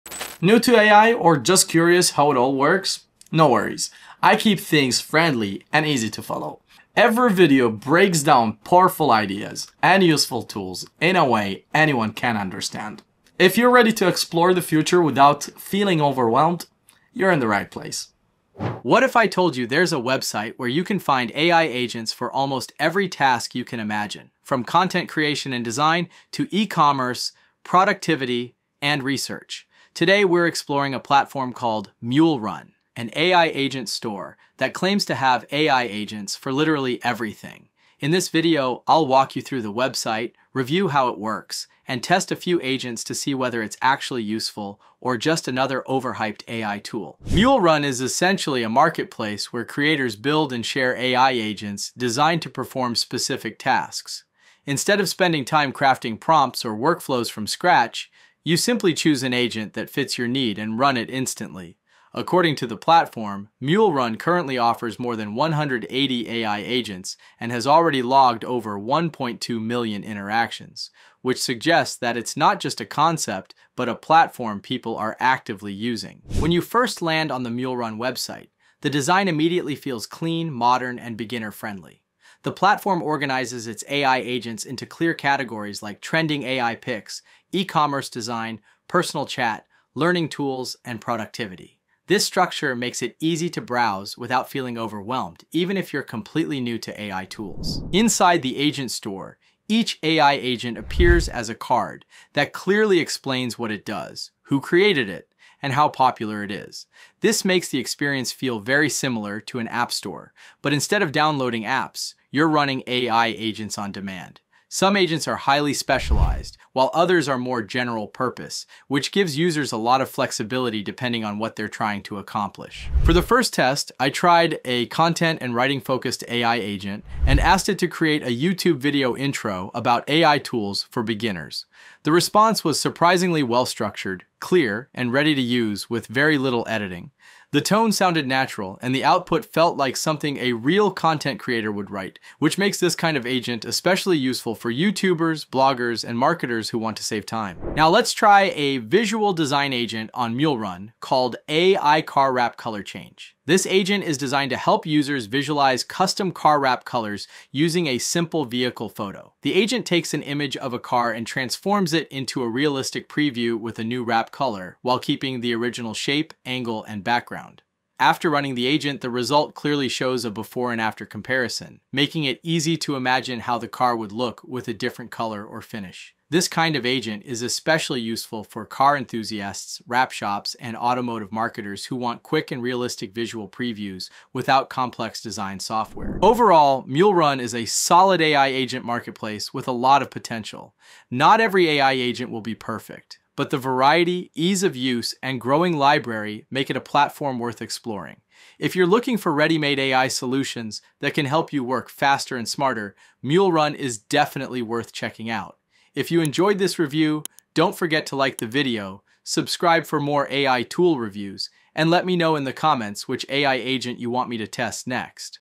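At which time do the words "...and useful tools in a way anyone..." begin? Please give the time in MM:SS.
00:09.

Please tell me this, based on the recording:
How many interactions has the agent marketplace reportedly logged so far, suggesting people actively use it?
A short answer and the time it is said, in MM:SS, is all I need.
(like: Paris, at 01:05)
Over 1.2 million, at 01:08.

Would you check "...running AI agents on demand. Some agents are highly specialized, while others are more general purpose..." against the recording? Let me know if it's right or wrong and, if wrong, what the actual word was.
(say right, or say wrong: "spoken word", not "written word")
right.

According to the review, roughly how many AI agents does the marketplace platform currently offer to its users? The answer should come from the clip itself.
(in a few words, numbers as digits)
More than 180.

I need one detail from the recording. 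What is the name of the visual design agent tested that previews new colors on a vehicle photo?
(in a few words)
AI Car Wrap Color Change.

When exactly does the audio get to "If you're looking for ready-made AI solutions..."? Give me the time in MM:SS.
03:18.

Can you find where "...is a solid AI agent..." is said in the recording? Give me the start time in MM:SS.
03:07.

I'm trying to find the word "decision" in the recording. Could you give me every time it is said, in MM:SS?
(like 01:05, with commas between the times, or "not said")
not said.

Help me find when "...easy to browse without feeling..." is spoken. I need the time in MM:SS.
01:33.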